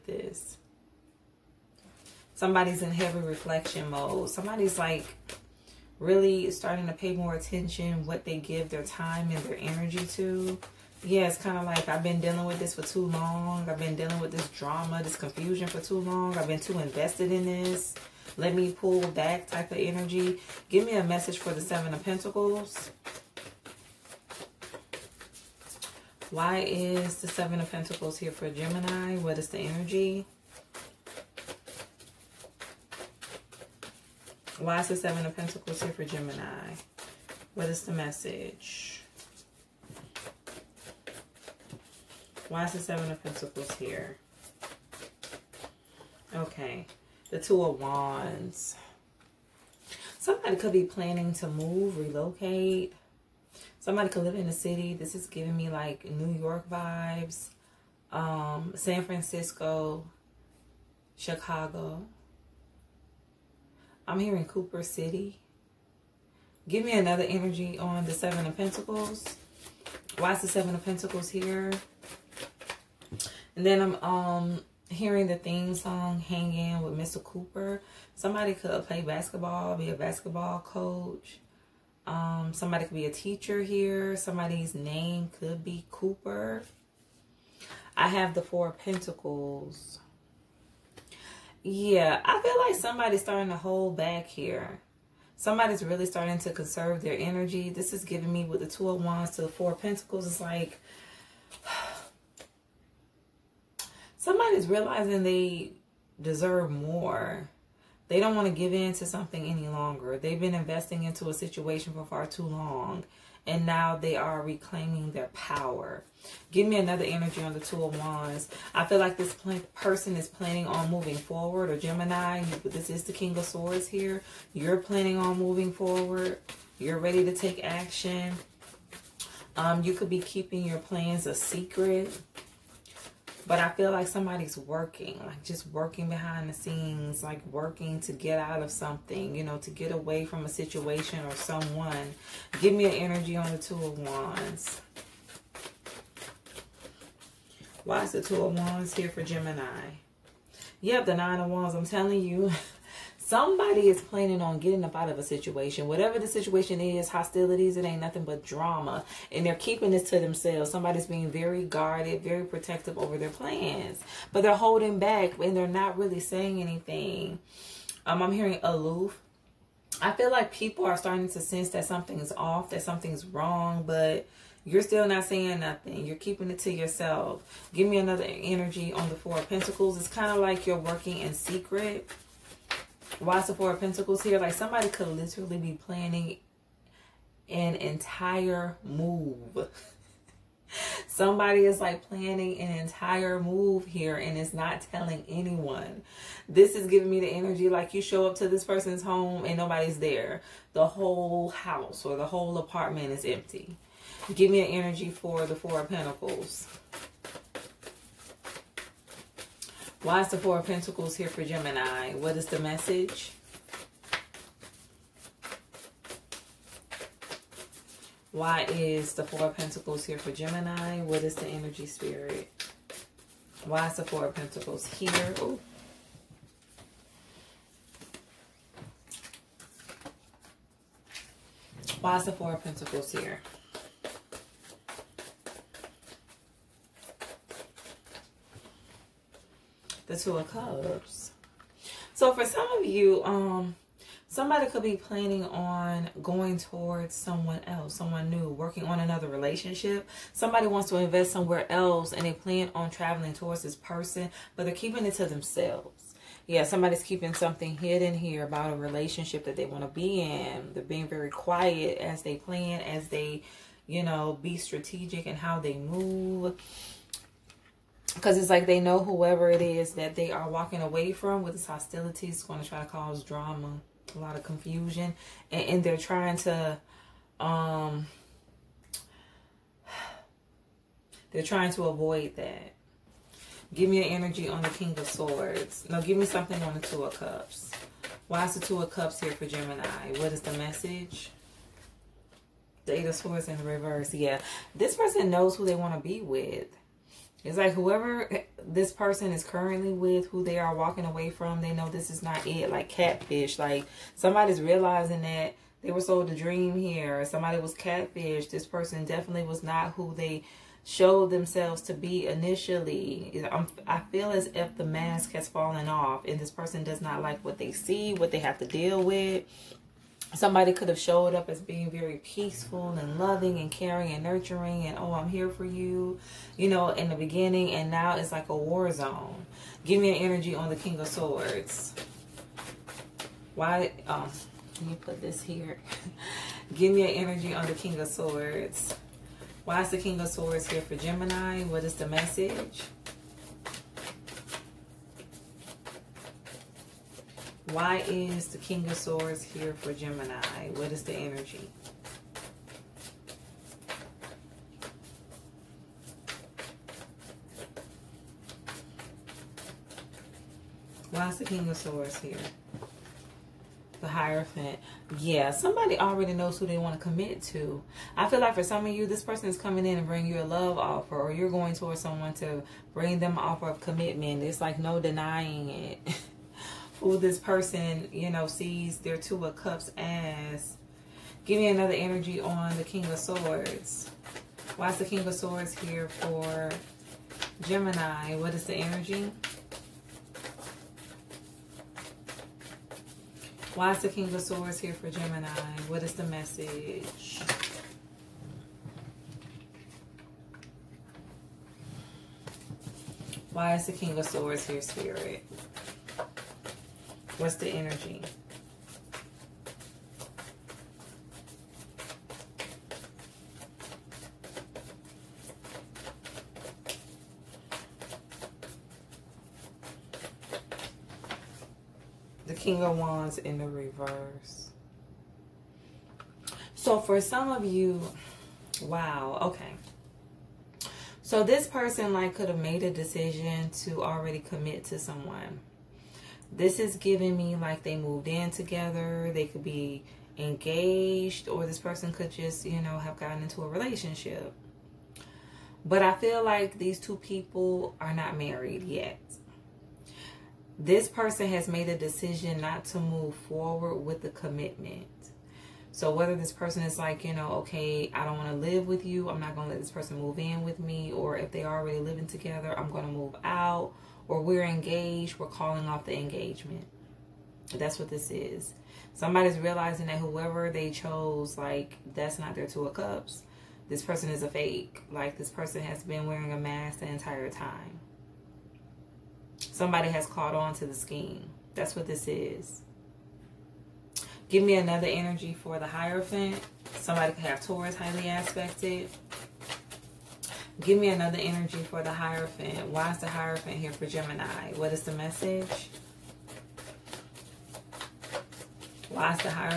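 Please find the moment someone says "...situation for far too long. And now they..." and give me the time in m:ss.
1:51.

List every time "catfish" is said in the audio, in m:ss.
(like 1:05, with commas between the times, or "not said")
5:02, 5:07.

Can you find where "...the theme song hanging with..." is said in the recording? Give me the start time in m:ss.
1:15.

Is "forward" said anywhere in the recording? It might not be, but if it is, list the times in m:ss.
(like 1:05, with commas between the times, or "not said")
2:01, 2:05, 7:33.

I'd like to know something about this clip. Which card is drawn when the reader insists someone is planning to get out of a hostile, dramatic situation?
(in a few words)
Nine of Wands.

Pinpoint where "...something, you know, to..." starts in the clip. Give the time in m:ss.
2:18.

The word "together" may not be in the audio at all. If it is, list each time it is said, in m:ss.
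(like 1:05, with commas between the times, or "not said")
7:18, 7:42.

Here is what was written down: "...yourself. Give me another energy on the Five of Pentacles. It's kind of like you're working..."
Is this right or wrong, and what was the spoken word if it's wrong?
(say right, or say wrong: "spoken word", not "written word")
wrong: "Four", not "Five".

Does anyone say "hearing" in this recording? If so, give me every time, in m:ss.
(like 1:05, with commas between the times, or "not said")
1:14, 2:48.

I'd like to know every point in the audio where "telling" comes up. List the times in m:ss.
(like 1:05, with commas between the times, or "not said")
2:31, 3:14.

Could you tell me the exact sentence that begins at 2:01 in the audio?
Or Gemini, this is the King of Swords here.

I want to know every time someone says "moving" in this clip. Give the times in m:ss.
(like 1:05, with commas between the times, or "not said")
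2:00, 2:05.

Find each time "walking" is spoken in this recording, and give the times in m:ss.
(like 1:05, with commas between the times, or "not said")
4:30, 5:00.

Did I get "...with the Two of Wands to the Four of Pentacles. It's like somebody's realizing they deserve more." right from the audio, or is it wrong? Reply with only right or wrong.
right.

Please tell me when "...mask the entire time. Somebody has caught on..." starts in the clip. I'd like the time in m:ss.
7:56.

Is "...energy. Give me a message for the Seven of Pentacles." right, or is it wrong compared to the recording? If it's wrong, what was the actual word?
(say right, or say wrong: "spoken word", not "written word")
right.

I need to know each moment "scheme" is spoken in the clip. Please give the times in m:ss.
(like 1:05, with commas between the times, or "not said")
8:00.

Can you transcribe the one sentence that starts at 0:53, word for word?
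Somebody could live in a city.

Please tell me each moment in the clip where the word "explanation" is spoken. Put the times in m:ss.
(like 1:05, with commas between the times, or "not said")
not said.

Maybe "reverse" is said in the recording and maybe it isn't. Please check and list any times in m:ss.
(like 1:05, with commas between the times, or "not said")
4:53, 7:03.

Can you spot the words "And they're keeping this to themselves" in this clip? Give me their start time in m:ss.
2:39.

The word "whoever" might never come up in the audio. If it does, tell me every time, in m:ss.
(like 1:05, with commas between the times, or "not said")
4:28, 4:57, 7:50.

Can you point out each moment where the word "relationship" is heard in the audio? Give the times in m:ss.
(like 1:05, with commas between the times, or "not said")
4:09, 4:18, 7:23.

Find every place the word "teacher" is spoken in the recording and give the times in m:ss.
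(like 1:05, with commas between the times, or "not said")
1:23.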